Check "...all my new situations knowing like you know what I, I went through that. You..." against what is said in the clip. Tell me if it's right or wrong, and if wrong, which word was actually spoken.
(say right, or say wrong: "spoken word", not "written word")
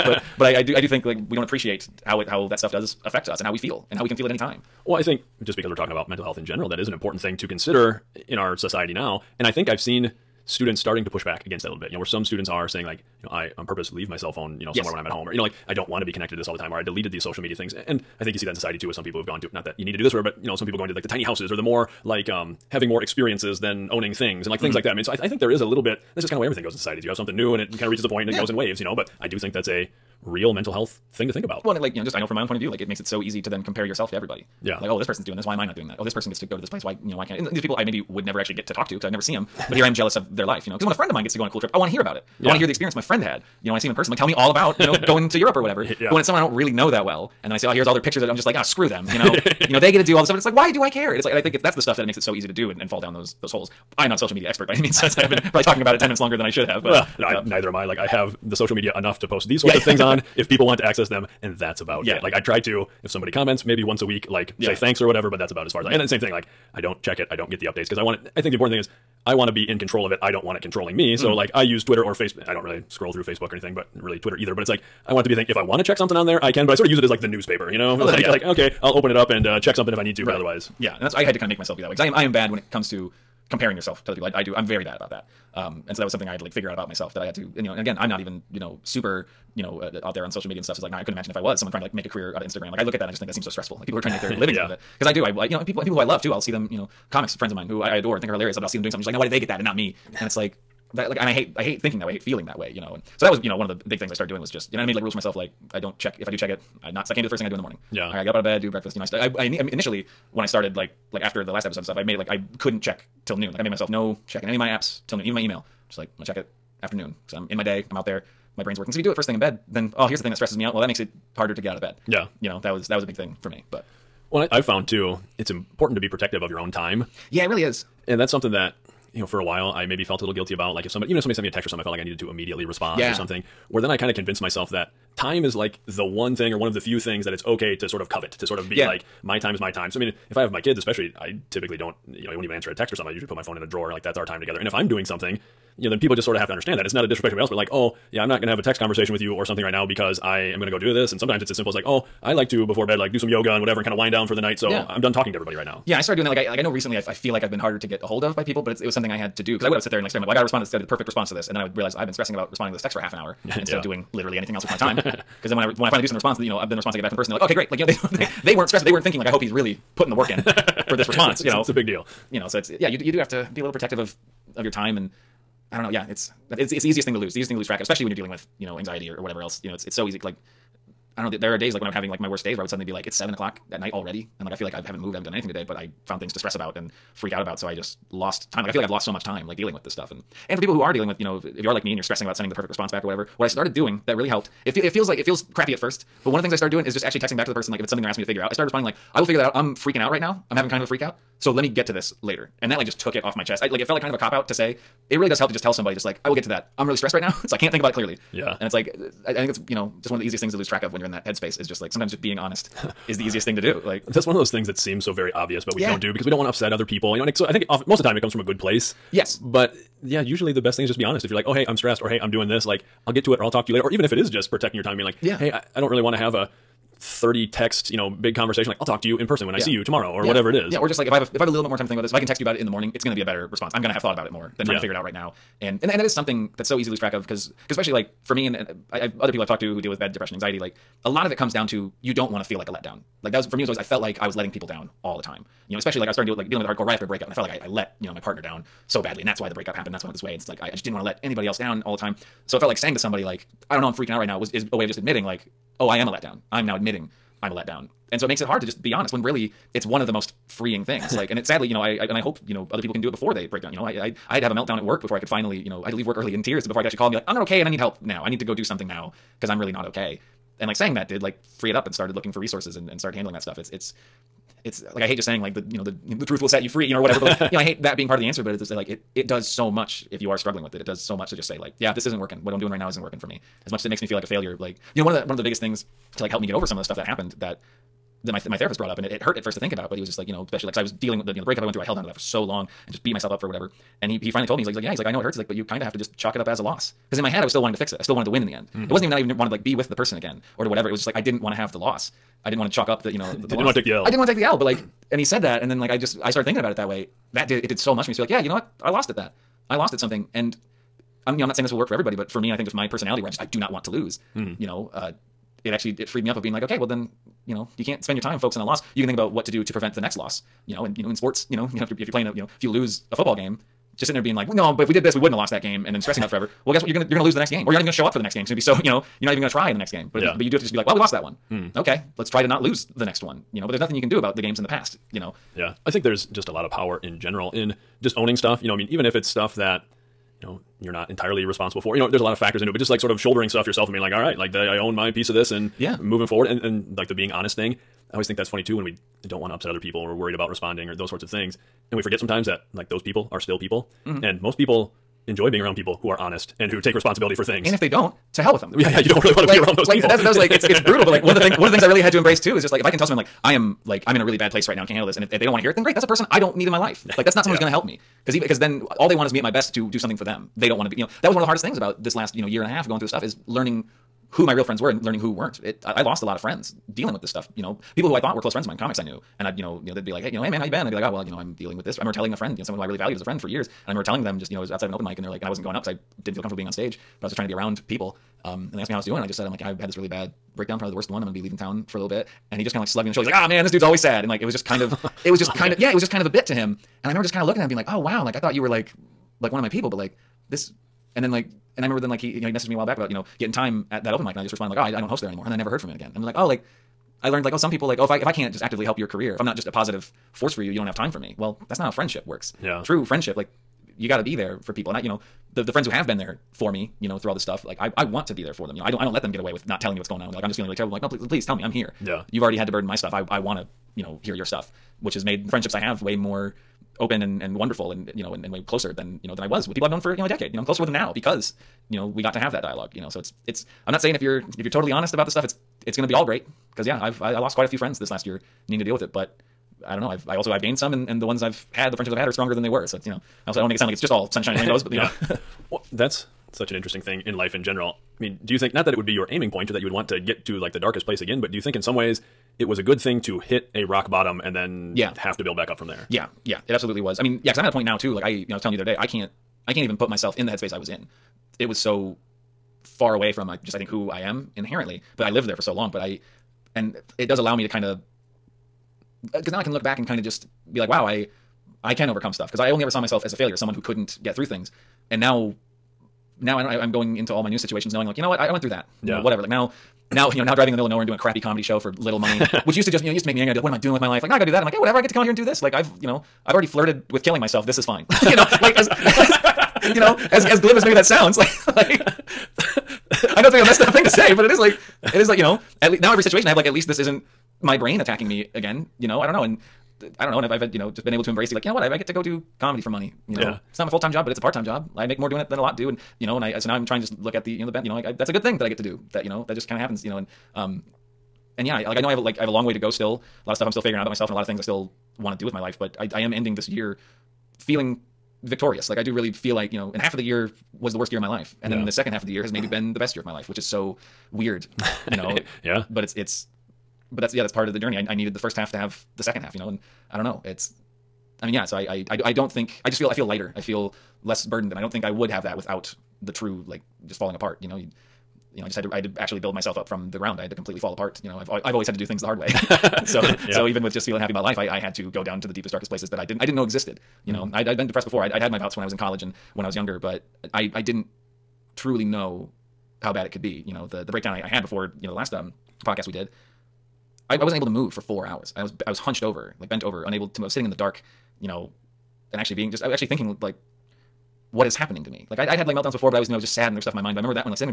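right.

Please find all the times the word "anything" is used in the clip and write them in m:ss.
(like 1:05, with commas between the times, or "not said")
1:13, 2:44, 3:05.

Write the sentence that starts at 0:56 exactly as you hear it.
But well, no, neither am I.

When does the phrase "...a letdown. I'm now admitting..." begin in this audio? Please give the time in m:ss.
4:16.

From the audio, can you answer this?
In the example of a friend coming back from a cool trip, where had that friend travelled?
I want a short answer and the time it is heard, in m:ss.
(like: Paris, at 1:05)
Europe, at 0:45.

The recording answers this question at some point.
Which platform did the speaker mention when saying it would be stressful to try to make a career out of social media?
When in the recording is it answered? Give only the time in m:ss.
1:32.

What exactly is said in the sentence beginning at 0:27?
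You have something new and it kind of reaches a point and it yeah.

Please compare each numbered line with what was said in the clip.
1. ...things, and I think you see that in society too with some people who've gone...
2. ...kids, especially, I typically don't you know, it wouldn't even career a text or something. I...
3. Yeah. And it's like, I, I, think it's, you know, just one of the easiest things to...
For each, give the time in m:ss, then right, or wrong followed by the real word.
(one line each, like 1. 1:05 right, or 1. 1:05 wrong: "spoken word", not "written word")
1. 0:17 right
2. 2:20 wrong: "answer", not "career"
3. 3:28 right.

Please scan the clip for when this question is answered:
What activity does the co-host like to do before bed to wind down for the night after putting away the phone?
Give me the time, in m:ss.
2:33.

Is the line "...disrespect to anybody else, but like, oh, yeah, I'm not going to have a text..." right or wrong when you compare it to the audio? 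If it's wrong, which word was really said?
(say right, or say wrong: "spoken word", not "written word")
right.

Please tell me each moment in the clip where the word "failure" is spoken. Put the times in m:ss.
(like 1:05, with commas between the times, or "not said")
4:44, 7:53.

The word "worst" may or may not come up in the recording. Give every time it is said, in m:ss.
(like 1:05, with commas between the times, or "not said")
3:02, 6:30, 8:40.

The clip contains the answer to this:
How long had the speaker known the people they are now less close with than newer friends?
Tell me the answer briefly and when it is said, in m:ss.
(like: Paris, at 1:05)
a decade, at 7:10.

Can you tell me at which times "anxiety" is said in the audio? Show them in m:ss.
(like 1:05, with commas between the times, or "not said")
2:58, 4:00.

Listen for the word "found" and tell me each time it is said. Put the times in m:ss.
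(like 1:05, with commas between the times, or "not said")
2:04, 3:06.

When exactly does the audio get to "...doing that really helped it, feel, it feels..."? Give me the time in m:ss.
3:13.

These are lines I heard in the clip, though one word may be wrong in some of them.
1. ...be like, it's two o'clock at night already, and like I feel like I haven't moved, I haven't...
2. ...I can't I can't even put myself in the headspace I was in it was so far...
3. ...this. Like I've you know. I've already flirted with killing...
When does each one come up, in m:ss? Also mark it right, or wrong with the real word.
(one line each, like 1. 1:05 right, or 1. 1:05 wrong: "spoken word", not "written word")
1. 3:02 wrong: "seven", not "two"
2. 7:38 right
3. 8:05 right.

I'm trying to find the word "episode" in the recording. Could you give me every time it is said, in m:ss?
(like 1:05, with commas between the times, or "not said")
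1:51.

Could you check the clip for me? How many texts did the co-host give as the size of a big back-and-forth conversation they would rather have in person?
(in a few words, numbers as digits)
30.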